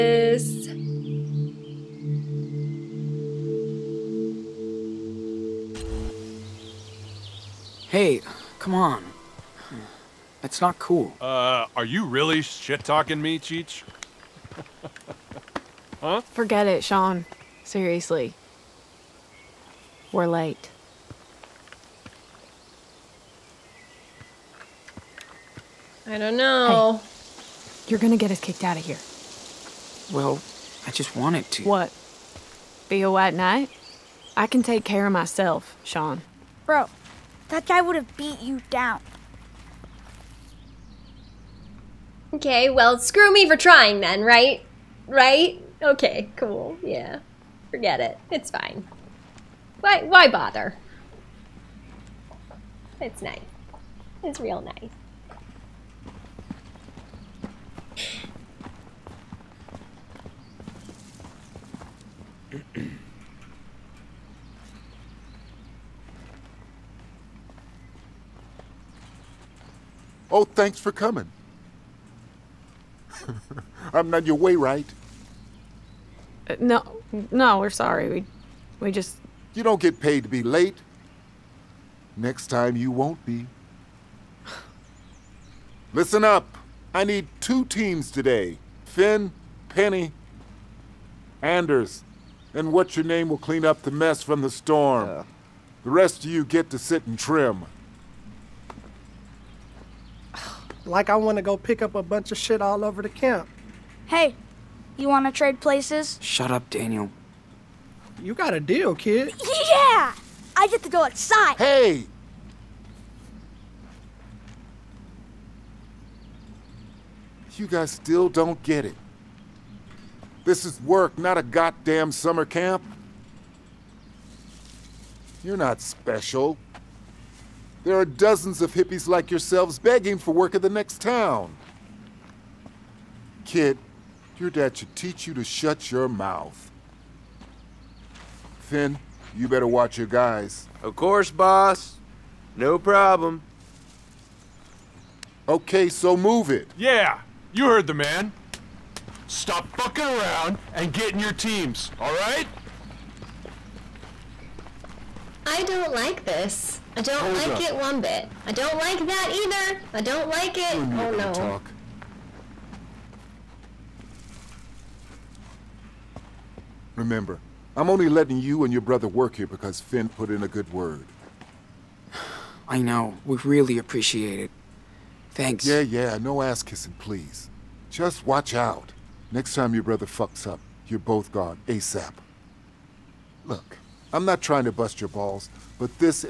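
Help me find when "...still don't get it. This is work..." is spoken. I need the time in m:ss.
1:57.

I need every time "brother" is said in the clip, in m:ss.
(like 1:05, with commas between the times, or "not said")
2:48, 2:59.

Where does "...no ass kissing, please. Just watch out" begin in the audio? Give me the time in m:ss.
2:56.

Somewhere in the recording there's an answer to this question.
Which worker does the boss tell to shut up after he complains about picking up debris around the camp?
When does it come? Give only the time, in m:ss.
1:46.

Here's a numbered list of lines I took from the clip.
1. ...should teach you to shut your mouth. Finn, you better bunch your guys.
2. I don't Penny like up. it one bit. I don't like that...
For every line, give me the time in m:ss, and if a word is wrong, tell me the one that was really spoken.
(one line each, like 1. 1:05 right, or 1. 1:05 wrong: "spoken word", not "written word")
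1. 2:14 wrong: "watch", not "bunch"
2. 2:36 wrong: "Hold", not "Penny".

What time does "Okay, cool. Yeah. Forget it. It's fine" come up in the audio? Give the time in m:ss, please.
0:45.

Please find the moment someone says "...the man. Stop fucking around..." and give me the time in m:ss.
2:27.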